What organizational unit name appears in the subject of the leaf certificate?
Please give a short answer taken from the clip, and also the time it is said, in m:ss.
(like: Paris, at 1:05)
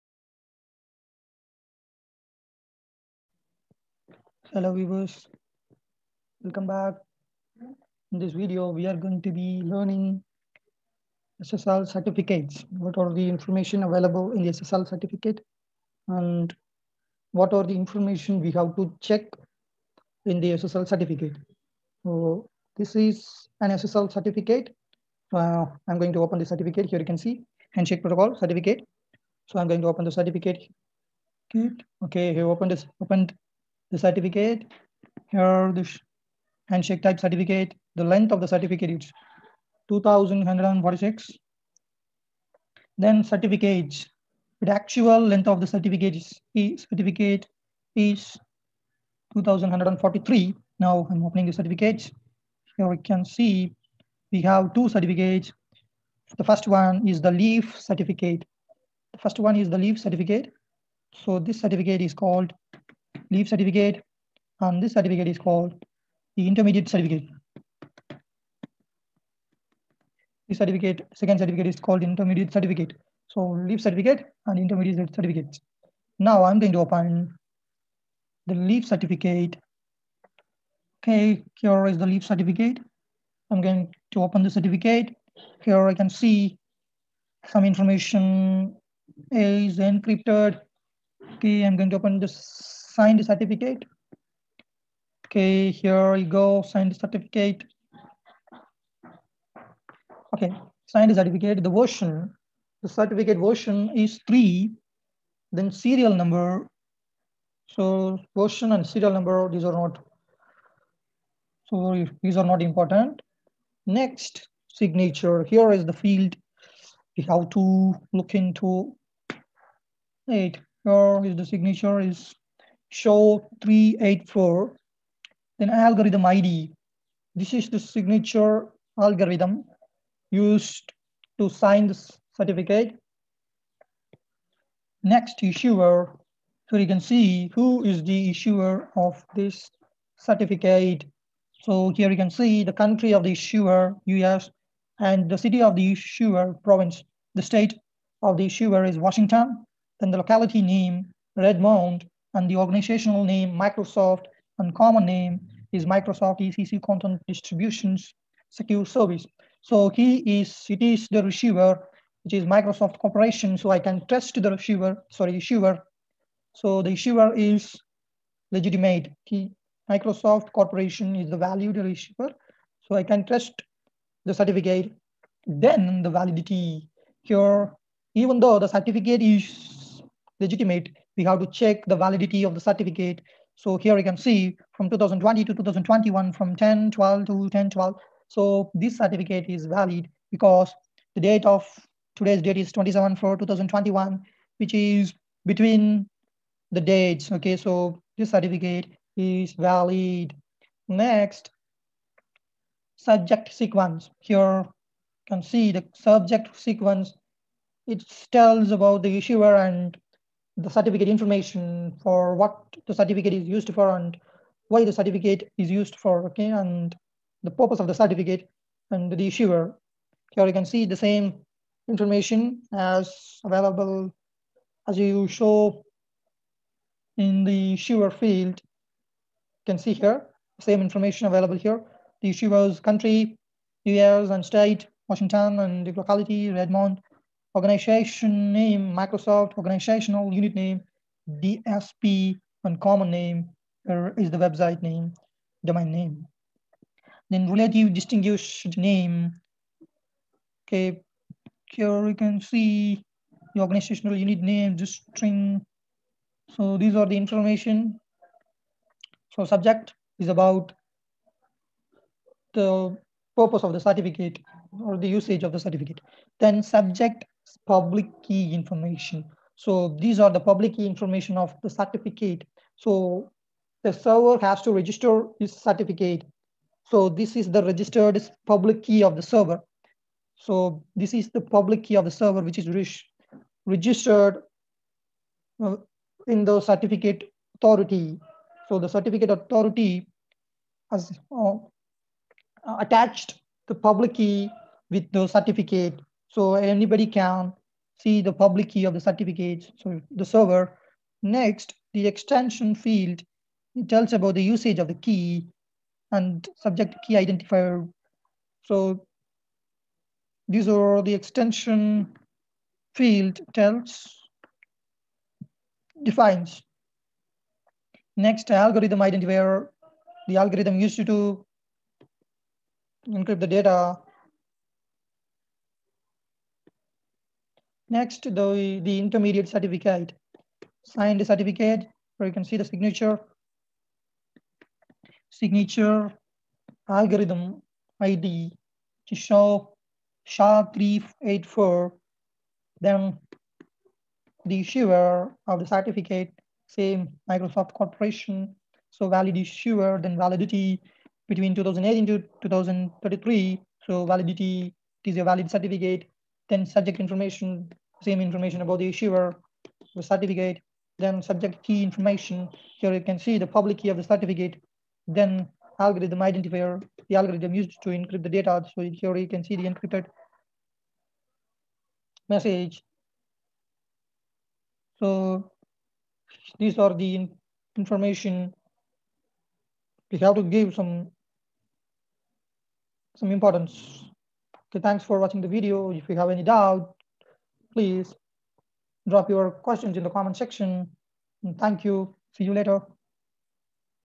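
DSP, at 4:01.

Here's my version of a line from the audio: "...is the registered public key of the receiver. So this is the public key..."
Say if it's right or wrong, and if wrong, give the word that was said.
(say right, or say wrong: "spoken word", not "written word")
wrong: "server", not "receiver".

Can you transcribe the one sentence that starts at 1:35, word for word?
Okay, here we go, sign the certificate.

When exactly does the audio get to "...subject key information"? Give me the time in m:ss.
6:01.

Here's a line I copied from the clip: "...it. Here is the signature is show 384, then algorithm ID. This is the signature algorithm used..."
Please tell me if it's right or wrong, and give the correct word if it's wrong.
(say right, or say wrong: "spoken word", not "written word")
right.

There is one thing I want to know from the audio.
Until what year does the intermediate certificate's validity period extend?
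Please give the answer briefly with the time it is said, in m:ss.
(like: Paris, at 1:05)
2033, at 5:52.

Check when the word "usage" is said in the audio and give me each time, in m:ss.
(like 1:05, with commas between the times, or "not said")
4:25, 5:04.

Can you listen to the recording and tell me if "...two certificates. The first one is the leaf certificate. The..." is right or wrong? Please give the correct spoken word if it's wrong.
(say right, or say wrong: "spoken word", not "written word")
right.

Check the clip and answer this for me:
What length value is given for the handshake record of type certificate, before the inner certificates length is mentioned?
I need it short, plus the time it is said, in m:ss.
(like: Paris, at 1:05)
2146, at 0:39.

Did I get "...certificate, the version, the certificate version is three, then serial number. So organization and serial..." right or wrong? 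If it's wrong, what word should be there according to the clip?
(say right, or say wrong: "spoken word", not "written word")
wrong: "version", not "organization".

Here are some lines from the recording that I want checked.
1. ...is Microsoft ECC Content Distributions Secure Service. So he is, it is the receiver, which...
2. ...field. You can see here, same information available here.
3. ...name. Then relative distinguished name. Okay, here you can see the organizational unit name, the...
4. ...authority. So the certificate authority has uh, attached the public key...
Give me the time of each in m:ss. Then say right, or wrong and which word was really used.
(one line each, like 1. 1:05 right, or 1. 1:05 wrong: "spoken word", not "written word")
1. 2:35 right
2. 3:48 right
3. 4:05 right
4. 4:47 right.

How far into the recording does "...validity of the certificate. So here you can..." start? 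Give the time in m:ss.
3:01.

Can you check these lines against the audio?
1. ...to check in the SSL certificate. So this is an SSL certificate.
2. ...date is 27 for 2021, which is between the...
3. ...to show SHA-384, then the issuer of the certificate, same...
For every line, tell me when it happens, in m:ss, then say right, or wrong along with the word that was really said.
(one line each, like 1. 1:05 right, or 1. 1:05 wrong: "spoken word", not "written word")
1. 0:18 right
2. 3:12 right
3. 5:39 right.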